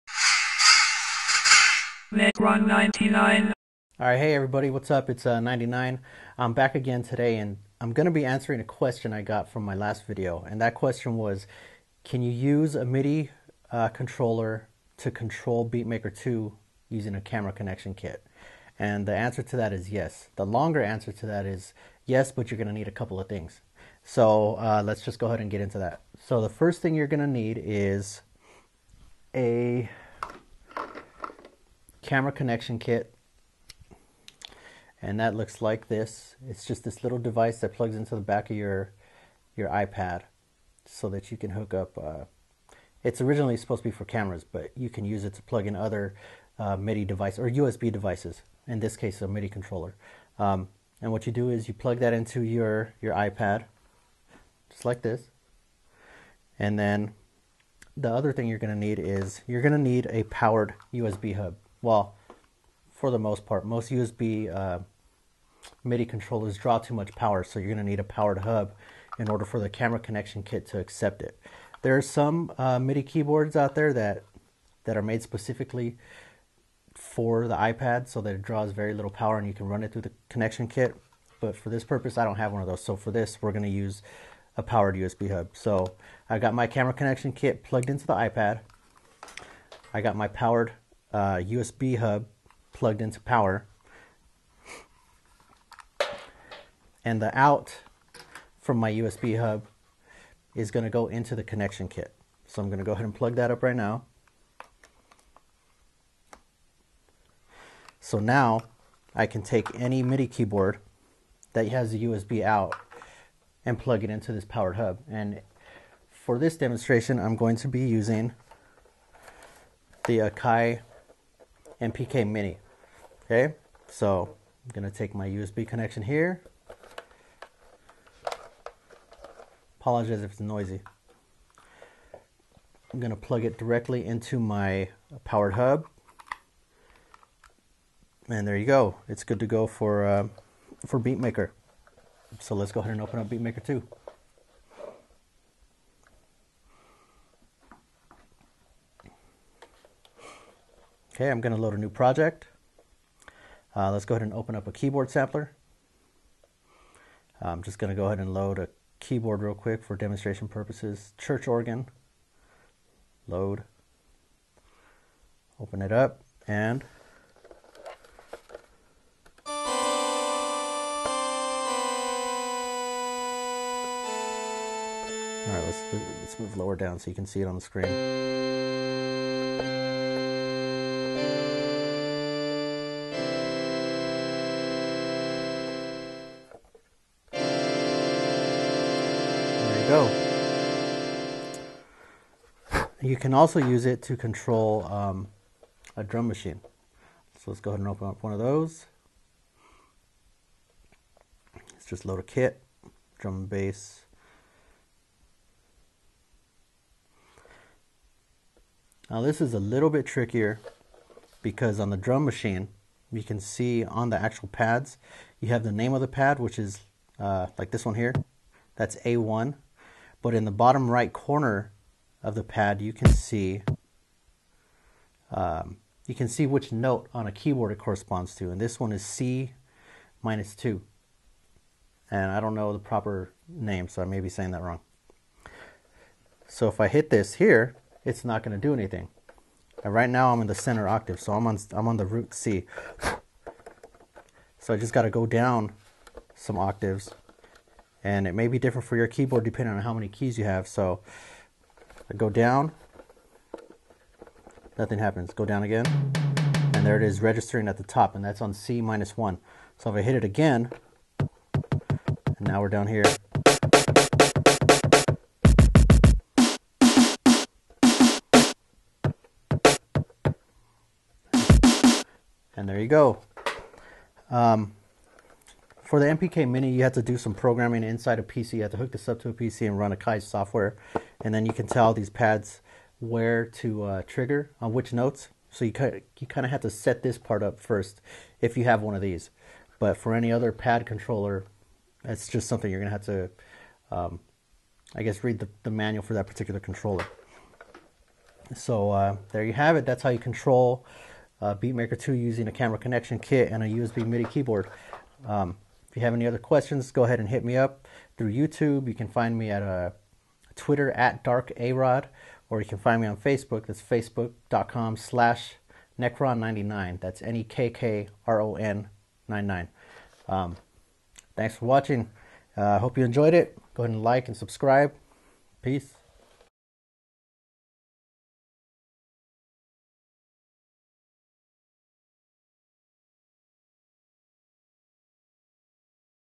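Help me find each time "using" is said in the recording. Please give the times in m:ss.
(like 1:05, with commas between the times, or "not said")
0:16, 1:57, 5:02.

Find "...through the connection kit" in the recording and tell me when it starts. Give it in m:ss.
1:19.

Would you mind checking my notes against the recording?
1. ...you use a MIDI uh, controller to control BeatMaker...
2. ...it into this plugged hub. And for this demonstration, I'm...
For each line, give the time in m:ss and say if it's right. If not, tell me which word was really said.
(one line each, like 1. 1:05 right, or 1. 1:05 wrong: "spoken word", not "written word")
1. 0:12 right
2. 1:54 wrong: "powered", not "plugged".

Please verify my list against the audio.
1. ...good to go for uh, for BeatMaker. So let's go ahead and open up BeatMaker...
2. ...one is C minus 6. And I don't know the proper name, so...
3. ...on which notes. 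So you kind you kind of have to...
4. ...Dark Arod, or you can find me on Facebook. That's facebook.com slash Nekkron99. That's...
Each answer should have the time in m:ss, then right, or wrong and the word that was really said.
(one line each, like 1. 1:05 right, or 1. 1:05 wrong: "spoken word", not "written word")
1. 2:19 right
2. 3:48 wrong: "2", not "6"
3. 4:44 right
4. 5:11 right.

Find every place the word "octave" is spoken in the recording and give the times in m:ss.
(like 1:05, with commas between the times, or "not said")
4:00, 4:06.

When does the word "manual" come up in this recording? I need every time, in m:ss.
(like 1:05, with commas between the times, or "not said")
4:55.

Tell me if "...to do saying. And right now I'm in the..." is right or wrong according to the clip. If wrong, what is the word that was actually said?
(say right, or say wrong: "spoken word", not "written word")
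wrong: "anything", not "saying".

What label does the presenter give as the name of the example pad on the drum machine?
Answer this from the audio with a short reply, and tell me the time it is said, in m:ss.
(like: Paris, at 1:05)
A1, at 3:39.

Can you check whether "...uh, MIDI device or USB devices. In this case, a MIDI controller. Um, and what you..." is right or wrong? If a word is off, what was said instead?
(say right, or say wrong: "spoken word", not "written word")
right.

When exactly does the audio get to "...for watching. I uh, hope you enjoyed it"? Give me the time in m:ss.
5:21.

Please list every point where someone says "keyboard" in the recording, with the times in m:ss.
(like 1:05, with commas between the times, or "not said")
1:13, 1:50, 2:34, 2:38, 3:47, 4:09, 5:04.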